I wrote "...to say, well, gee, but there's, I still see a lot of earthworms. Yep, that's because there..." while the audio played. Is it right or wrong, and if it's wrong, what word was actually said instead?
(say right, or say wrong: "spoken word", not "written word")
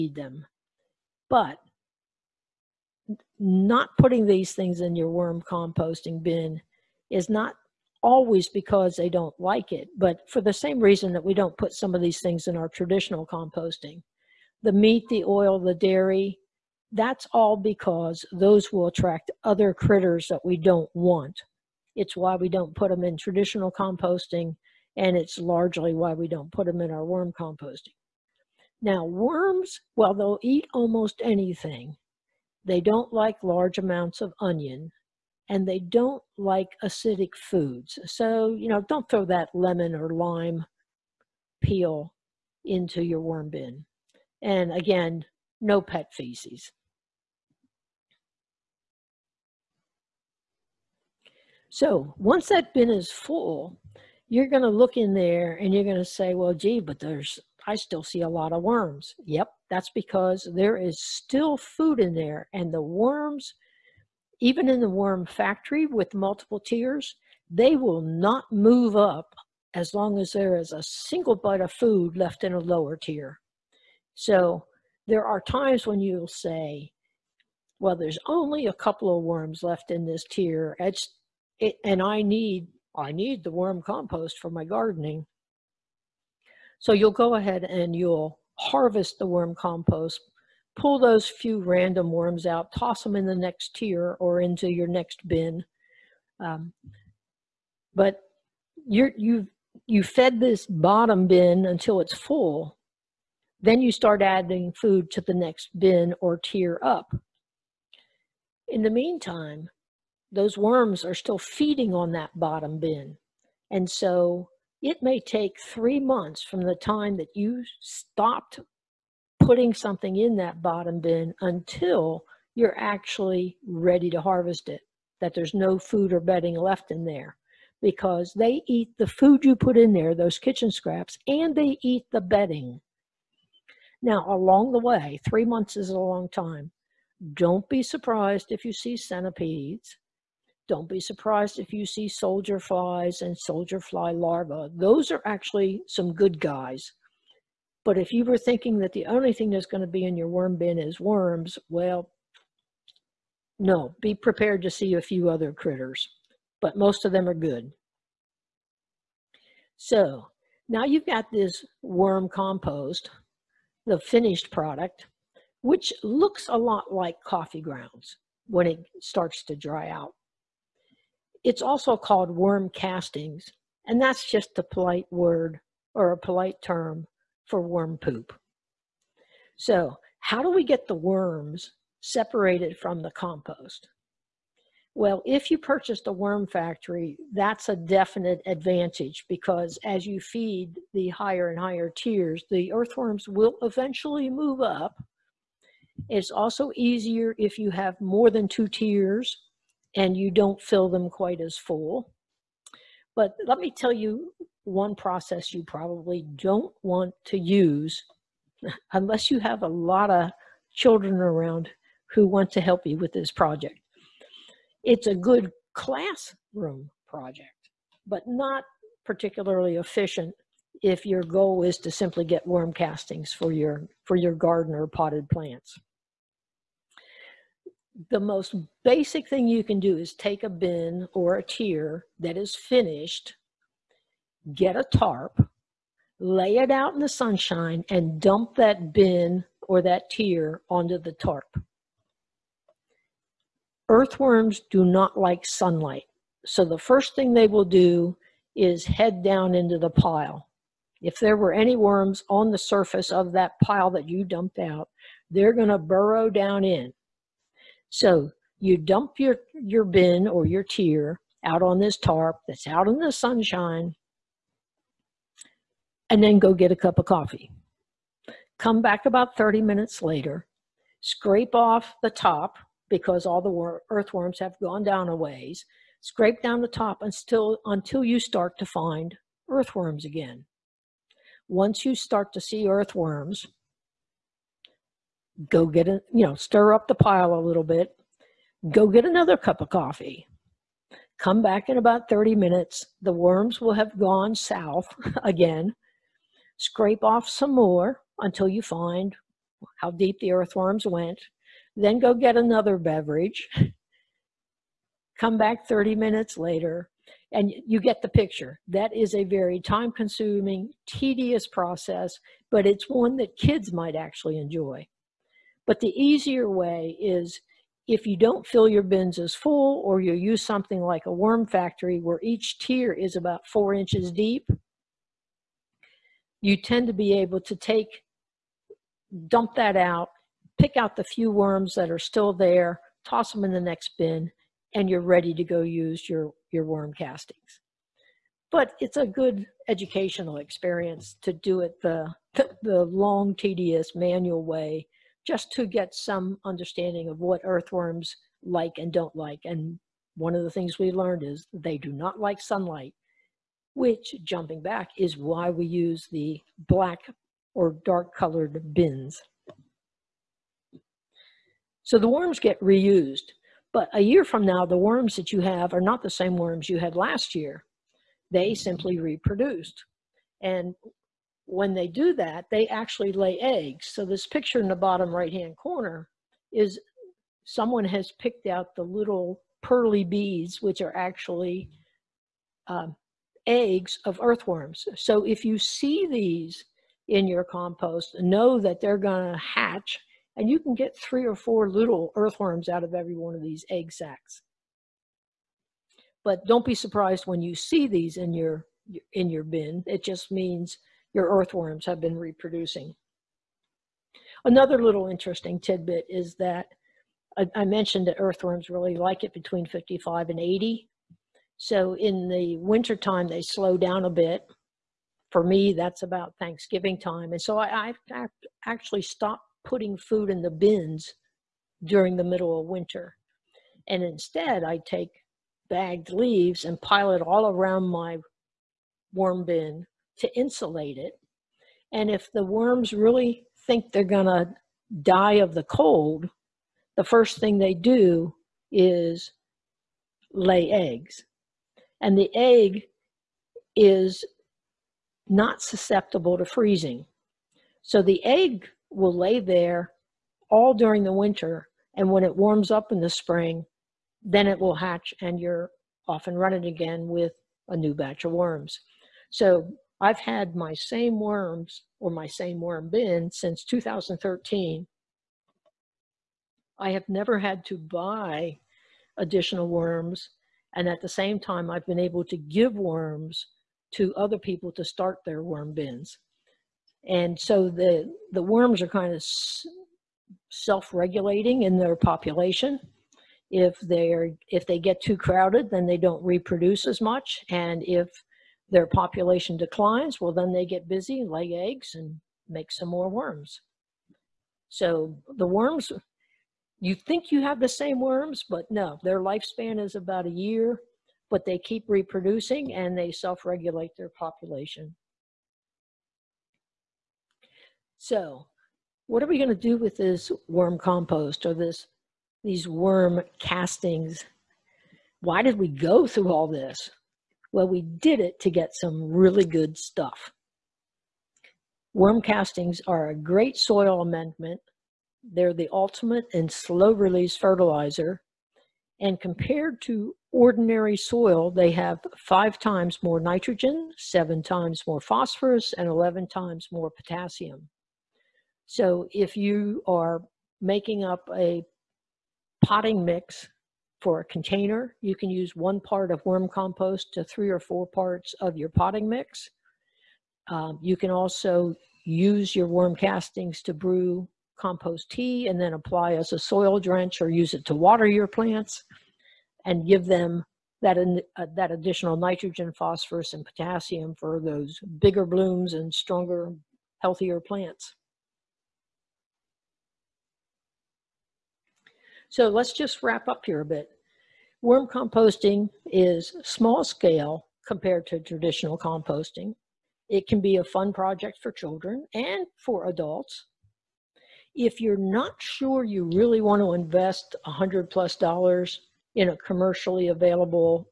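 wrong: "worms", not "earthworms".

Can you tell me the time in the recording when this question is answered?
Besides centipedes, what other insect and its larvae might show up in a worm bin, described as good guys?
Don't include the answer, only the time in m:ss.
2:22.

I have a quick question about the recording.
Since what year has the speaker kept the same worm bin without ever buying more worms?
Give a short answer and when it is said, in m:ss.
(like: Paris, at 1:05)
2013, at 7:43.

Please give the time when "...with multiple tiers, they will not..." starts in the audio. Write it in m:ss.
1:05.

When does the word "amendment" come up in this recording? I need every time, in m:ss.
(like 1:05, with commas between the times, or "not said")
8:43.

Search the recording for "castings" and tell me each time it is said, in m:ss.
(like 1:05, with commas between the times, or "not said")
2:52, 3:42, 5:36, 8:33, 8:42, 9:12.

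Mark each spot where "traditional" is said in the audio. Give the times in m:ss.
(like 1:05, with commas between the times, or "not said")
0:12, 0:23, 9:38.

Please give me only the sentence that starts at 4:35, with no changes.
Scrape down the top until, until you start to find earthworms again.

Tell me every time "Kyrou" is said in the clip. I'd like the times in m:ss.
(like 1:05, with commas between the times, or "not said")
not said.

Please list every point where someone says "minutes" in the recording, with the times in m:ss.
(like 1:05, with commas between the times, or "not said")
4:29, 4:52, 5:05.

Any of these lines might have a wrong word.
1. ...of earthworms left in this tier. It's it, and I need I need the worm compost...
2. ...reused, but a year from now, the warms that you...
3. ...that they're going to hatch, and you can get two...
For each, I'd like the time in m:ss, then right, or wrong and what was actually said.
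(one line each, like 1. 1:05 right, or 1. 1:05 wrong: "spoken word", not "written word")
1. 1:19 wrong: "worms", not "earthworms"
2. 6:02 wrong: "worms", not "warms"
3. 6:28 wrong: "three", not "two".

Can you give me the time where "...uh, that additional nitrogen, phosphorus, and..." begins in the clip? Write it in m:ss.
9:21.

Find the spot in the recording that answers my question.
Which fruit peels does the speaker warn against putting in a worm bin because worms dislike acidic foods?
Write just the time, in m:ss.
0:39.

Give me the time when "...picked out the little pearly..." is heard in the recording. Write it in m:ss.
6:18.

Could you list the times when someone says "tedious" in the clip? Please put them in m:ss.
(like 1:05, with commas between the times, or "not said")
5:10, 5:43.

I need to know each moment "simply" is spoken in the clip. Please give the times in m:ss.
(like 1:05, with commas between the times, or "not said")
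3:41, 6:08.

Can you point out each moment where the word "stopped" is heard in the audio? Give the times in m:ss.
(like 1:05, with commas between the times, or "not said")
1:57, 6:59.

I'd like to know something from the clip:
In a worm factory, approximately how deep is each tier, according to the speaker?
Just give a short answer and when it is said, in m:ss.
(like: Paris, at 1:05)
4 inches, at 5:23.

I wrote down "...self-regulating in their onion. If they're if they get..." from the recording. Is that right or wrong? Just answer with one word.
wrong.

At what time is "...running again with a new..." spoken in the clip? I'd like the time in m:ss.
7:36.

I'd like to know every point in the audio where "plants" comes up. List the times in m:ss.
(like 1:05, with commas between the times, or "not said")
3:45, 9:18, 9:27.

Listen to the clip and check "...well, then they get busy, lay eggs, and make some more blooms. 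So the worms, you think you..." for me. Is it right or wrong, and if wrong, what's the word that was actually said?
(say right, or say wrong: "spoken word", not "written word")
wrong: "worms", not "blooms".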